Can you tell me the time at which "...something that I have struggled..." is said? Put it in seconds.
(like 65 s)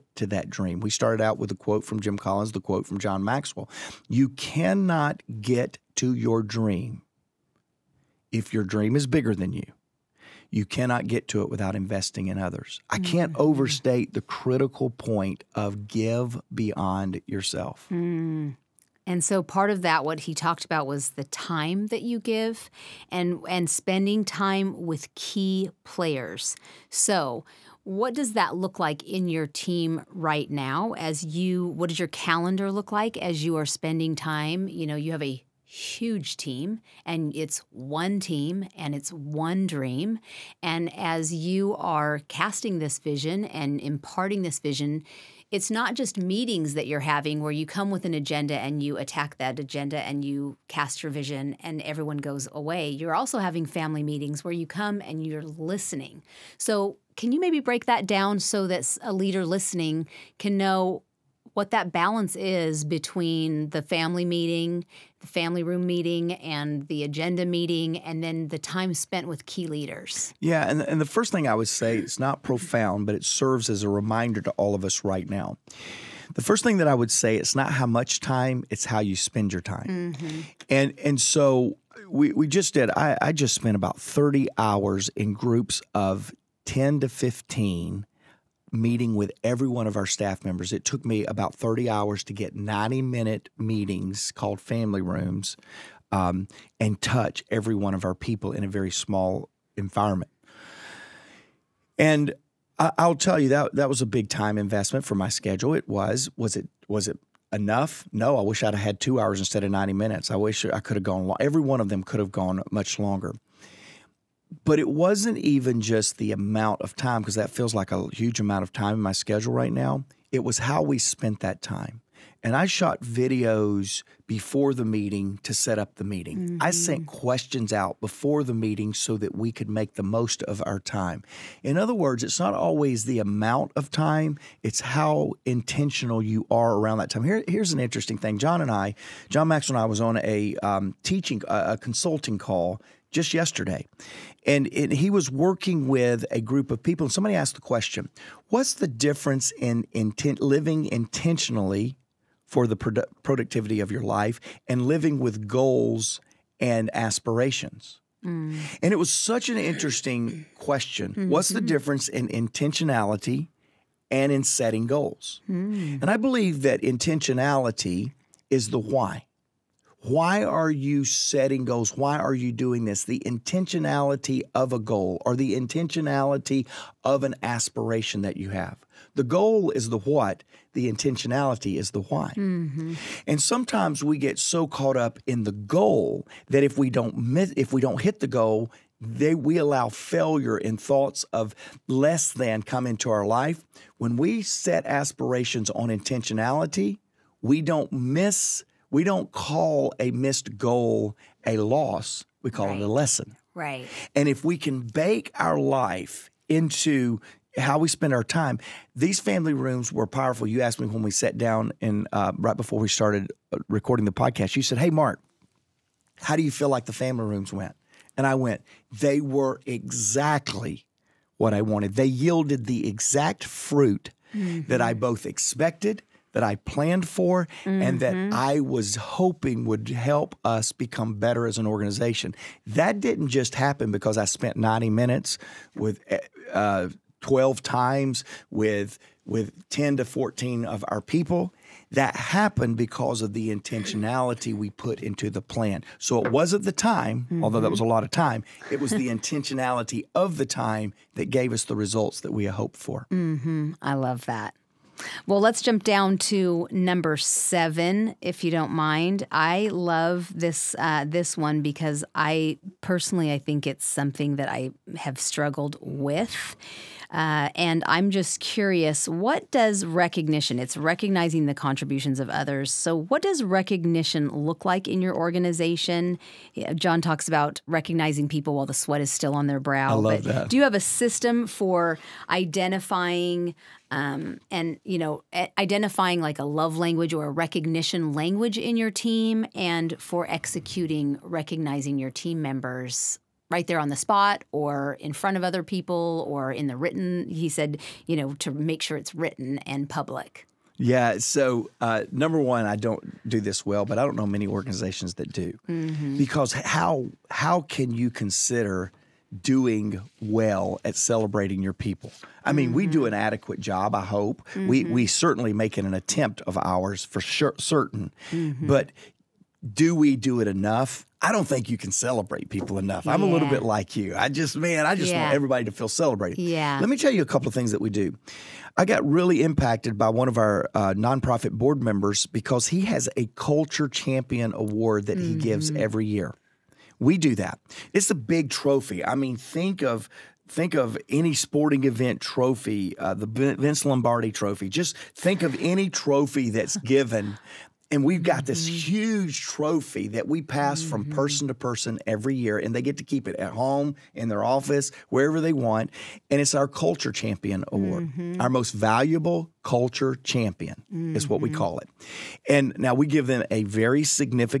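263 s.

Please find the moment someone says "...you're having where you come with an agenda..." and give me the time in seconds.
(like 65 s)
46 s.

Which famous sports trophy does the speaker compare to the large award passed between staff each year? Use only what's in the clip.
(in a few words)
Vince Lombardi trophy.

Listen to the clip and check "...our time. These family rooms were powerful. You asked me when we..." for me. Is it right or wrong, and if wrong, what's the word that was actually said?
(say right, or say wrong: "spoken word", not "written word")
right.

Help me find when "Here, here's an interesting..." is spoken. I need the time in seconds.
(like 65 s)
137 s.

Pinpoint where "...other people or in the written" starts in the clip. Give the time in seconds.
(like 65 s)
295 s.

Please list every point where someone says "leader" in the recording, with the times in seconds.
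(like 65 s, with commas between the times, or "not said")
59 s, 69 s.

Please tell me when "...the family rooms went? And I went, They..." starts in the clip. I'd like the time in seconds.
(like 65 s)
216 s.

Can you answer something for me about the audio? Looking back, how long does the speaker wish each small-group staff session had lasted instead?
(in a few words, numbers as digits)
2 hours.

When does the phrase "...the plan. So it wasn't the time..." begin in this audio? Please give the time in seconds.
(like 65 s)
245 s.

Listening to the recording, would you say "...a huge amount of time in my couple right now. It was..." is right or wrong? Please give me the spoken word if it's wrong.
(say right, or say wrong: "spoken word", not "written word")
wrong: "schedule", not "couple".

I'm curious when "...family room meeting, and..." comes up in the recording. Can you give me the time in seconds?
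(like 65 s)
65 s.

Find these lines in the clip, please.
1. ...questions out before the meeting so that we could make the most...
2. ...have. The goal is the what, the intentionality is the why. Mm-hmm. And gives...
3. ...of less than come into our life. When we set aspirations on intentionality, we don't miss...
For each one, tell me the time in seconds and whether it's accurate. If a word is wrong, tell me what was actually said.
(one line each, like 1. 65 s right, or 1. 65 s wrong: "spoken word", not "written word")
1. 127 s right
2. 178 s wrong: "sometimes", not "gives"
3. 191 s right.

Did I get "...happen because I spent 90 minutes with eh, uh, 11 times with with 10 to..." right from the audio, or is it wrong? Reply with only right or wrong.
wrong.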